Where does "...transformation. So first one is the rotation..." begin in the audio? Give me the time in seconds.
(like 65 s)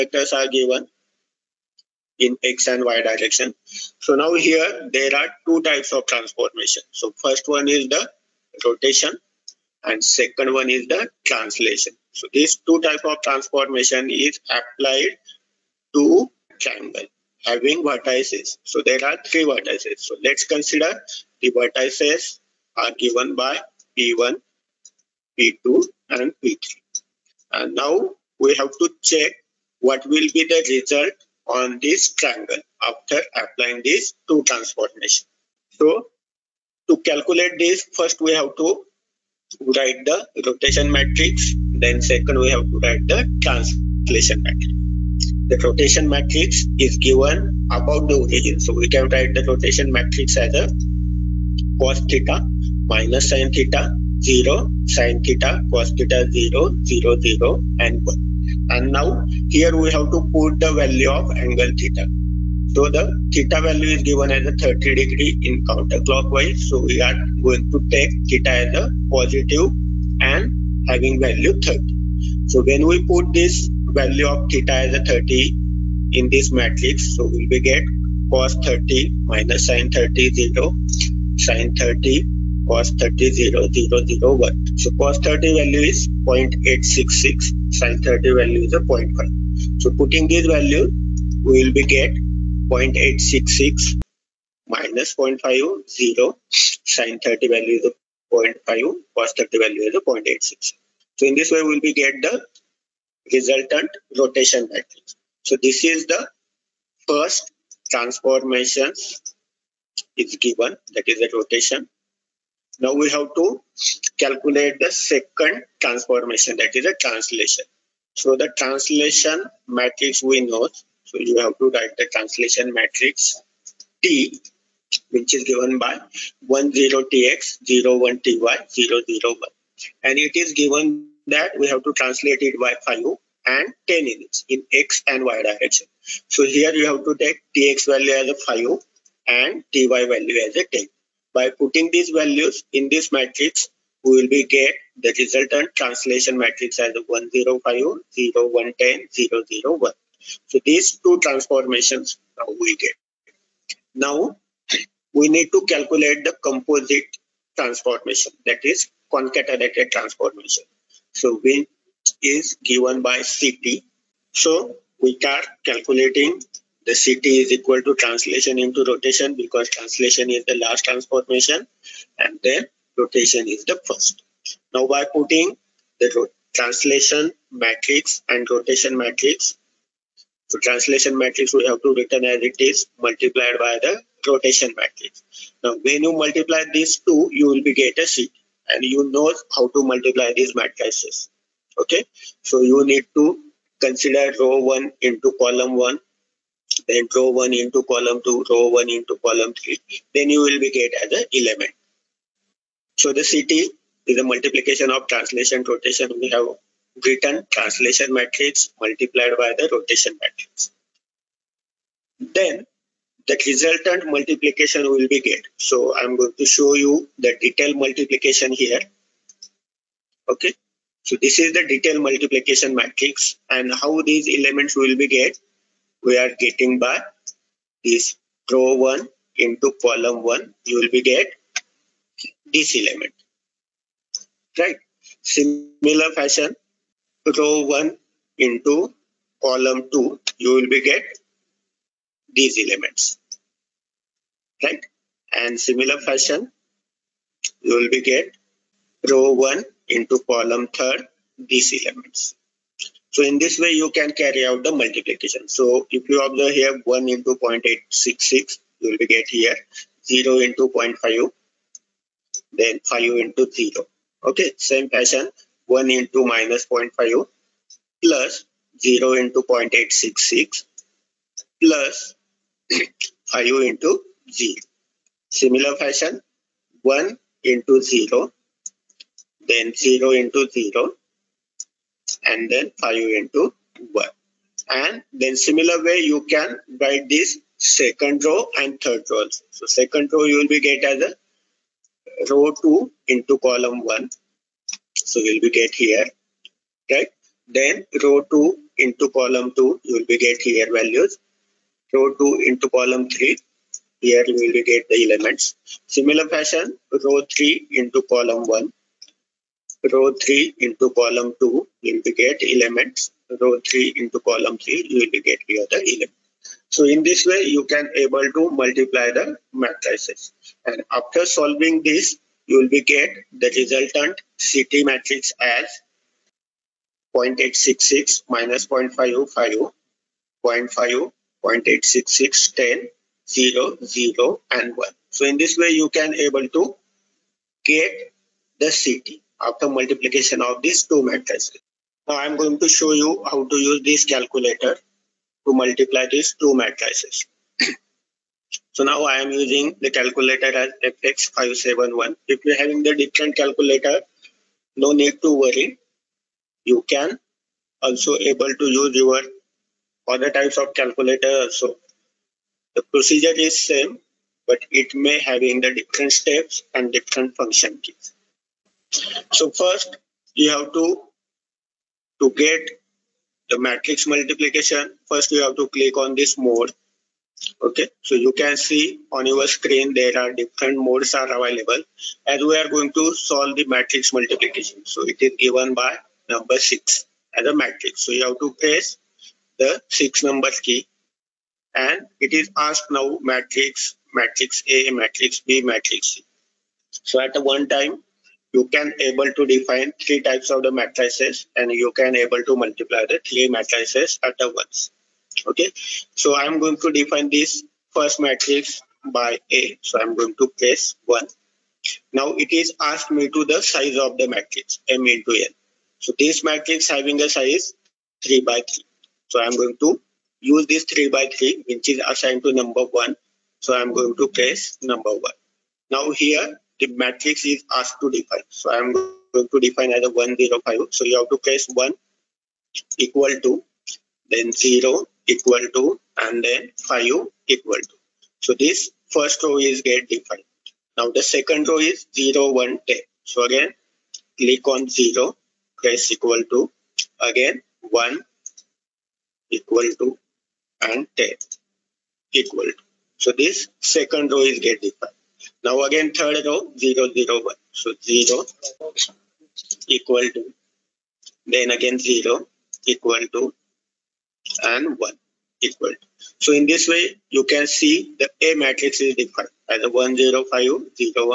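6 s.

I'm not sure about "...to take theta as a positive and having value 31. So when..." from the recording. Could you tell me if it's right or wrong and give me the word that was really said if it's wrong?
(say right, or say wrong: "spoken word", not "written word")
wrong: "30", not "31".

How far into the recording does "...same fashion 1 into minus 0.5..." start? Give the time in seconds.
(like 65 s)
264 s.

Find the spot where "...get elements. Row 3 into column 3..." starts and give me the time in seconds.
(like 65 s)
312 s.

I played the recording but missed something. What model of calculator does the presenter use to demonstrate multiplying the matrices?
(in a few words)
FX571.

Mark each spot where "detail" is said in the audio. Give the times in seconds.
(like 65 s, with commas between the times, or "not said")
217 s, 221 s.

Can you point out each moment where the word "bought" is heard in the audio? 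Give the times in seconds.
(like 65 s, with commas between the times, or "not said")
not said.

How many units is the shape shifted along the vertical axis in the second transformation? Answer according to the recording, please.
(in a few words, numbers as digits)
10.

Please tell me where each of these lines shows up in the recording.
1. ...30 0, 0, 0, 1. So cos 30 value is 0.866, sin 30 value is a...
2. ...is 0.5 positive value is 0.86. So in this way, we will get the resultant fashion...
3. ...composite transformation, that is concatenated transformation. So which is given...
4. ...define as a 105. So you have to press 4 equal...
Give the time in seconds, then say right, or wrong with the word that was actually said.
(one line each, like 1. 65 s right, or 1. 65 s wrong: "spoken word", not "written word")
1. 82 s right
2. 97 s wrong: "rotation", not "fashion"
3. 156 s right
4. 429 s wrong: "1", not "4".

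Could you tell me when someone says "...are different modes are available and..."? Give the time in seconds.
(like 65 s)
380 s.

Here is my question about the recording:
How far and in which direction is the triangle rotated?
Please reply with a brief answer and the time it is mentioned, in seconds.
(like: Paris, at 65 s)
30 degrees counterclockwise, at 64 s.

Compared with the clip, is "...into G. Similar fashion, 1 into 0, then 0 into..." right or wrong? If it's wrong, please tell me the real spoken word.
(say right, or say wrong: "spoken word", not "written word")
right.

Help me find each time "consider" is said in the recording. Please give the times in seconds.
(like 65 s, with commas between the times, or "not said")
20 s, 193 s.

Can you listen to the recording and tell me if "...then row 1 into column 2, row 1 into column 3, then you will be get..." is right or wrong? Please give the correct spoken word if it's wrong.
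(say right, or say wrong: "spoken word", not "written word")
right.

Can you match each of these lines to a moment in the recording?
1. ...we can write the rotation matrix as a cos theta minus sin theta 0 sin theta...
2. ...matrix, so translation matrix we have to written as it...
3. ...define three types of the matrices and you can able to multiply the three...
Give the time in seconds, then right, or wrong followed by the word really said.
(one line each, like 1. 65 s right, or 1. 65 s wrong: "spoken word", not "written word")
1. 48 s right
2. 178 s right
3. 399 s right.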